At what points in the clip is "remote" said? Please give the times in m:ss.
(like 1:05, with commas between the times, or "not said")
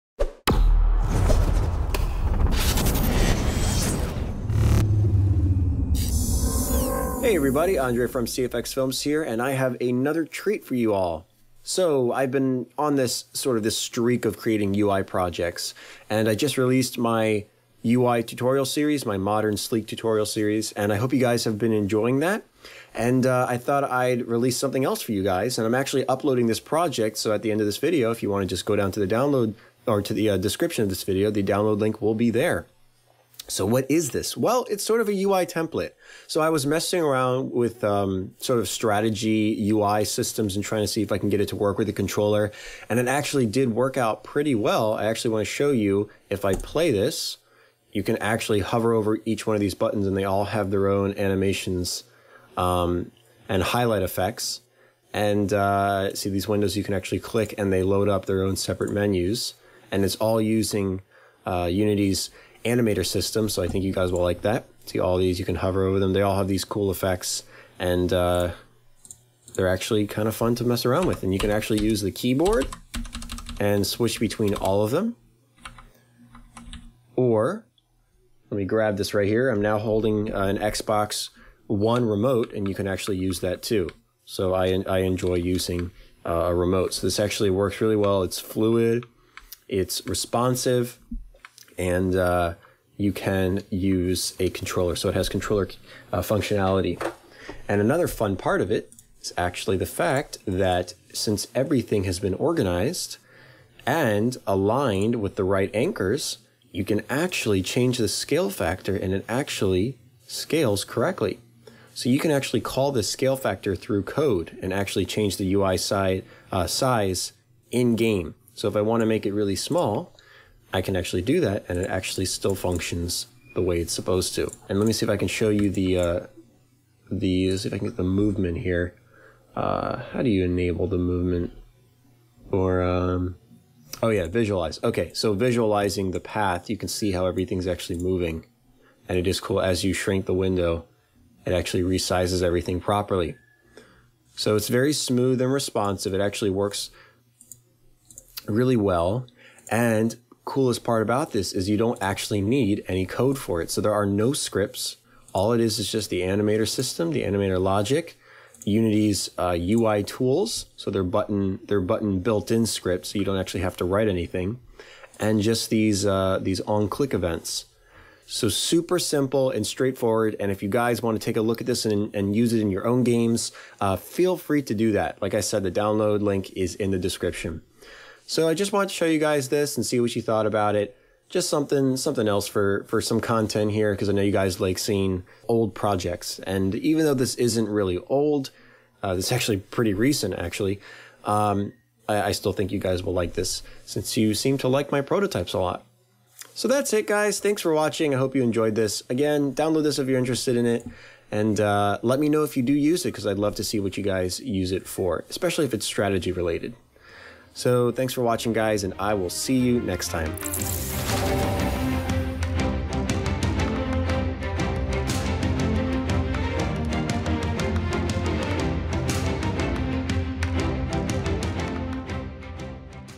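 1:22, 1:26.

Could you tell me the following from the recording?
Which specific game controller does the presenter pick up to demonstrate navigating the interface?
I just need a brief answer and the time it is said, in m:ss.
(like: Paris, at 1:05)
Xbox One, at 1:20.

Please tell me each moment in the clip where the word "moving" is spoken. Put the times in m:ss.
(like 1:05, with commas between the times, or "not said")
2:18.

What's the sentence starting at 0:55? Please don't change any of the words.
And uh, see these windows you can actually click and they load up their own separate menus.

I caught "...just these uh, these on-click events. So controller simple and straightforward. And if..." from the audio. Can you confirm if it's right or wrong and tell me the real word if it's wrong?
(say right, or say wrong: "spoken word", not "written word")
wrong: "super", not "controller".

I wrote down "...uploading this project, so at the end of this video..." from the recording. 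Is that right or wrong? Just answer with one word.
right.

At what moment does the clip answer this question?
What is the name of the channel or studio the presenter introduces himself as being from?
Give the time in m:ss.
0:08.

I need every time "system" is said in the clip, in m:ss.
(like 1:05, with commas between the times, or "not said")
0:40, 1:03, 2:36.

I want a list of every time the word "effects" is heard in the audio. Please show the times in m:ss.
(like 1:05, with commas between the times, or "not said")
0:54, 1:06.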